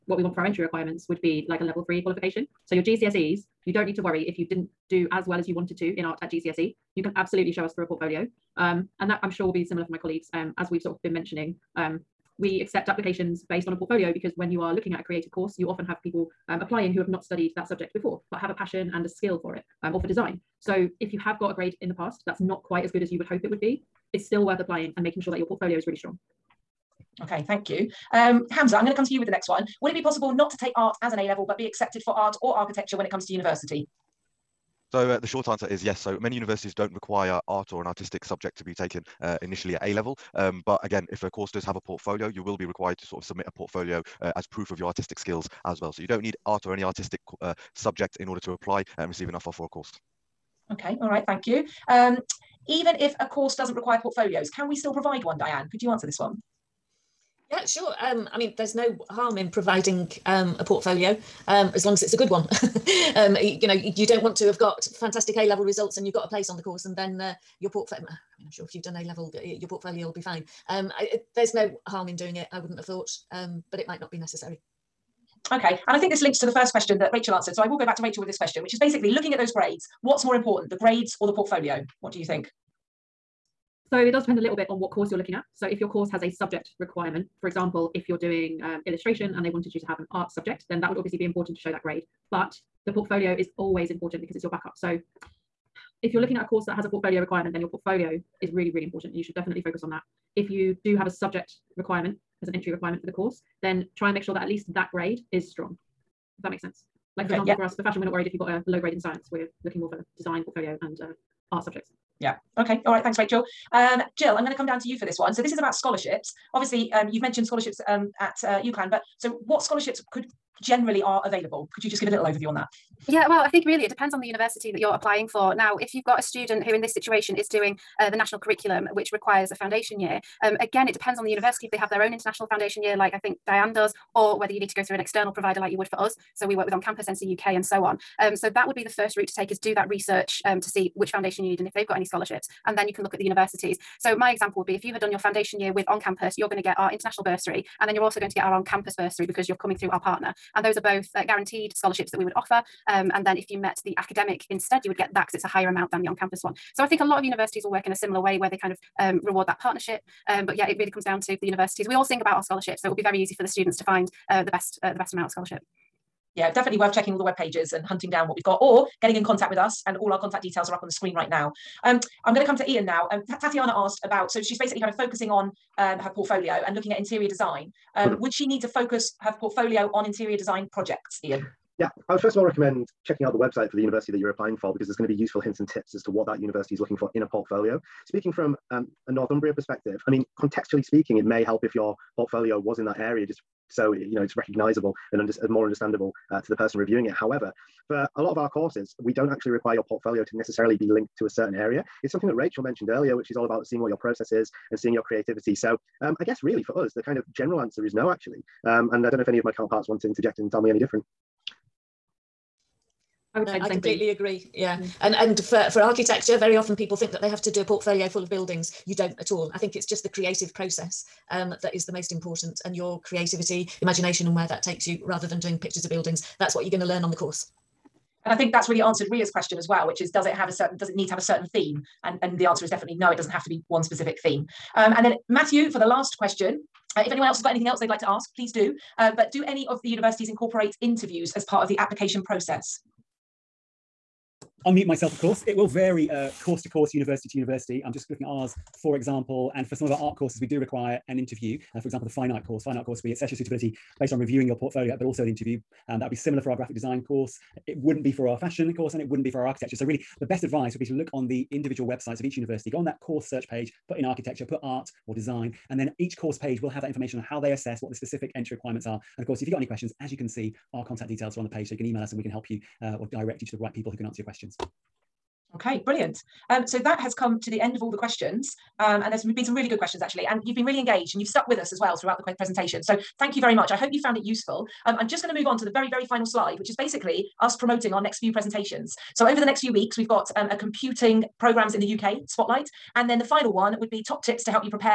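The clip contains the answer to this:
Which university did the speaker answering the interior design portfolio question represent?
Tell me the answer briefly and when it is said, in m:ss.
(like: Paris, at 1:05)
Northumbria, at 3:09.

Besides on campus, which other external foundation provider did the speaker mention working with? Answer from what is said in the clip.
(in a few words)
NCUK.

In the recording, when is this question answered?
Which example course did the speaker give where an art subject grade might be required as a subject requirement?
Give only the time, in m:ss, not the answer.
1:28.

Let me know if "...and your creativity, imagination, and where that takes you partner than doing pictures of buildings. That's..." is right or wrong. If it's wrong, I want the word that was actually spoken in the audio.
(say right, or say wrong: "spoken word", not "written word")
wrong: "rather", not "partner".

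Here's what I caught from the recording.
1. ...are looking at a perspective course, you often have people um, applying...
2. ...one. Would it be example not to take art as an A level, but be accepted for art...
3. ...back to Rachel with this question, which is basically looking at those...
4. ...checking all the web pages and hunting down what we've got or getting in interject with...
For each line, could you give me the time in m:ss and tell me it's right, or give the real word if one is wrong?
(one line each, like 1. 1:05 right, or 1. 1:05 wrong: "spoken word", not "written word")
1. 0:14 wrong: "creative", not "perspective"
2. 0:29 wrong: "possible", not "example"
3. 1:17 right
4. 2:46 wrong: "contact", not "interject".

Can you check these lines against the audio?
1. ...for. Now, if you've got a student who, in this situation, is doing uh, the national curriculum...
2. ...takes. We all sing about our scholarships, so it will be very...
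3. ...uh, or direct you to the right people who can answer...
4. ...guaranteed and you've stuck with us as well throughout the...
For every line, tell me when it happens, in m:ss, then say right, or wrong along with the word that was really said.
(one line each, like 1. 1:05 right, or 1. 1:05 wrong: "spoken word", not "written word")
1. 2:05 right
2. 2:41 wrong: "universities", not "takes"
3. 4:32 right
4. 4:40 wrong: "engaged", not "guaranteed".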